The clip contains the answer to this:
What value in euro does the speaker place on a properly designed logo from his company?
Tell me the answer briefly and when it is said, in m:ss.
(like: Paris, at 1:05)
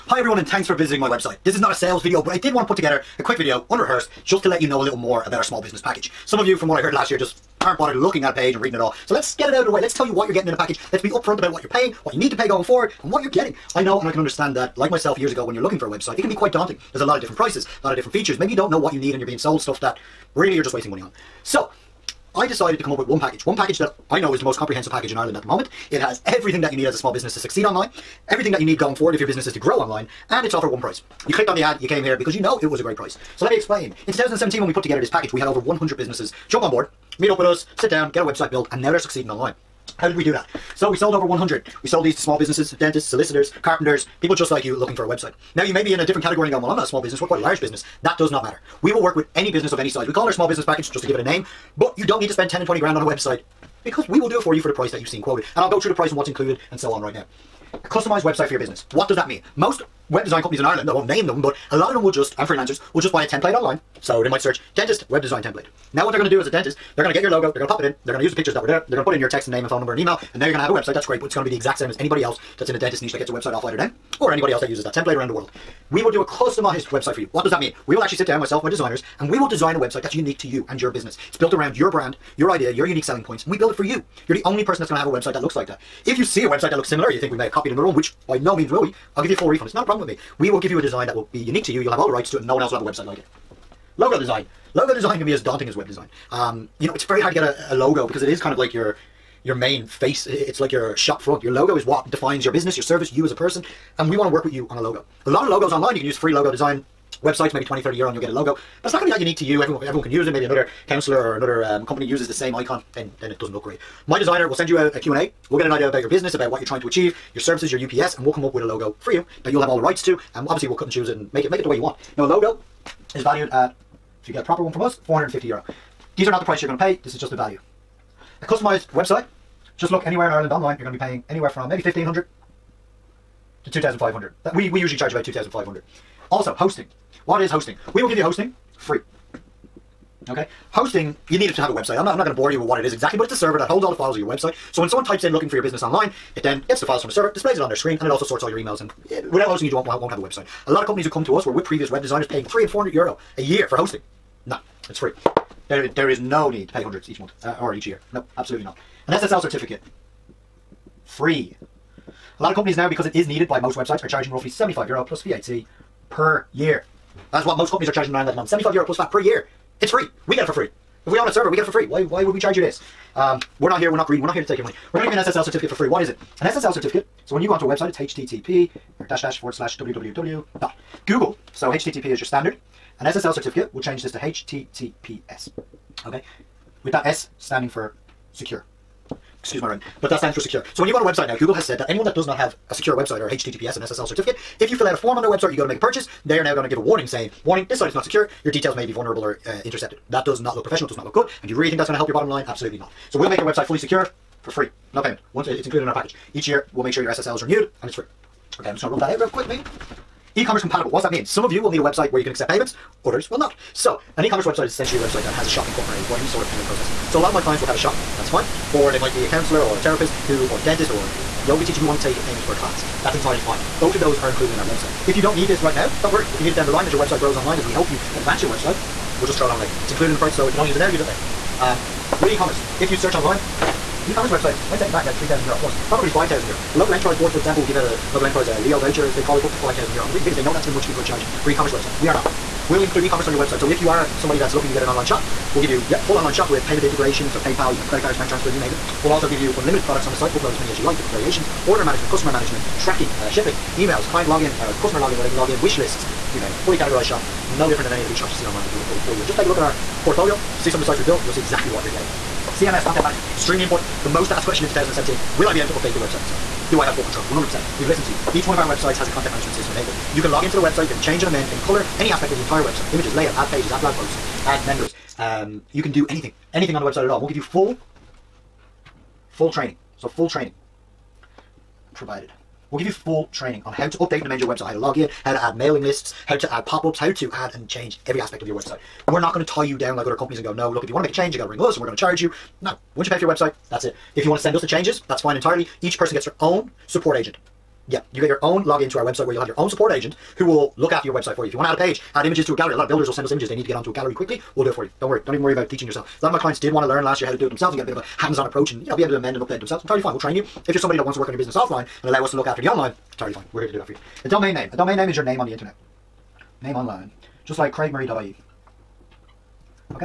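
450 euro, at 2:05.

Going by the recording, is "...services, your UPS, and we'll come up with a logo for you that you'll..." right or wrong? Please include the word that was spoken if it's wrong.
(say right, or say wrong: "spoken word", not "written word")
right.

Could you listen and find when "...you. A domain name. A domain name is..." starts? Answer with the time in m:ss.
5:13.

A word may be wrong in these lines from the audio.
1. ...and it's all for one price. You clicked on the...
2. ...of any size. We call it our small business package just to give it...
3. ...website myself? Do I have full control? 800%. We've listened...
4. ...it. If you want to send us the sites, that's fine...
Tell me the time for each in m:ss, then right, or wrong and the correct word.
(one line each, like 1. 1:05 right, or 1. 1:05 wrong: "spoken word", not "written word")
1. 0:30 right
2. 0:49 right
3. 4:25 wrong: "100", not "800"
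4. 4:53 wrong: "changes", not "sites".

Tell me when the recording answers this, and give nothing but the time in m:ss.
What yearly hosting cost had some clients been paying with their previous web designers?
2:32.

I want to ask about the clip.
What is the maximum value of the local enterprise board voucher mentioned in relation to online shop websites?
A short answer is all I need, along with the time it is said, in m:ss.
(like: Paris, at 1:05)
5,000 euro, at 3:59.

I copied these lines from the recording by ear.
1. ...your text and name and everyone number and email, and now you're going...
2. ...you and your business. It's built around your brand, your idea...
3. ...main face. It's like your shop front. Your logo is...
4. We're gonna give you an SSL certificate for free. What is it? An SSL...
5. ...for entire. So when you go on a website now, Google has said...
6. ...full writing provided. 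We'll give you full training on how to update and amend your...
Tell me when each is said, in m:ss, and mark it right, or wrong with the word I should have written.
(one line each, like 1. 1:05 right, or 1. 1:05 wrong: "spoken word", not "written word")
1. 1:09 wrong: "phone", not "everyone"
2. 1:20 right
3. 1:39 right
4. 2:54 right
5. 3:10 wrong: "secure", not "entire"
6. 4:40 wrong: "training", not "writing".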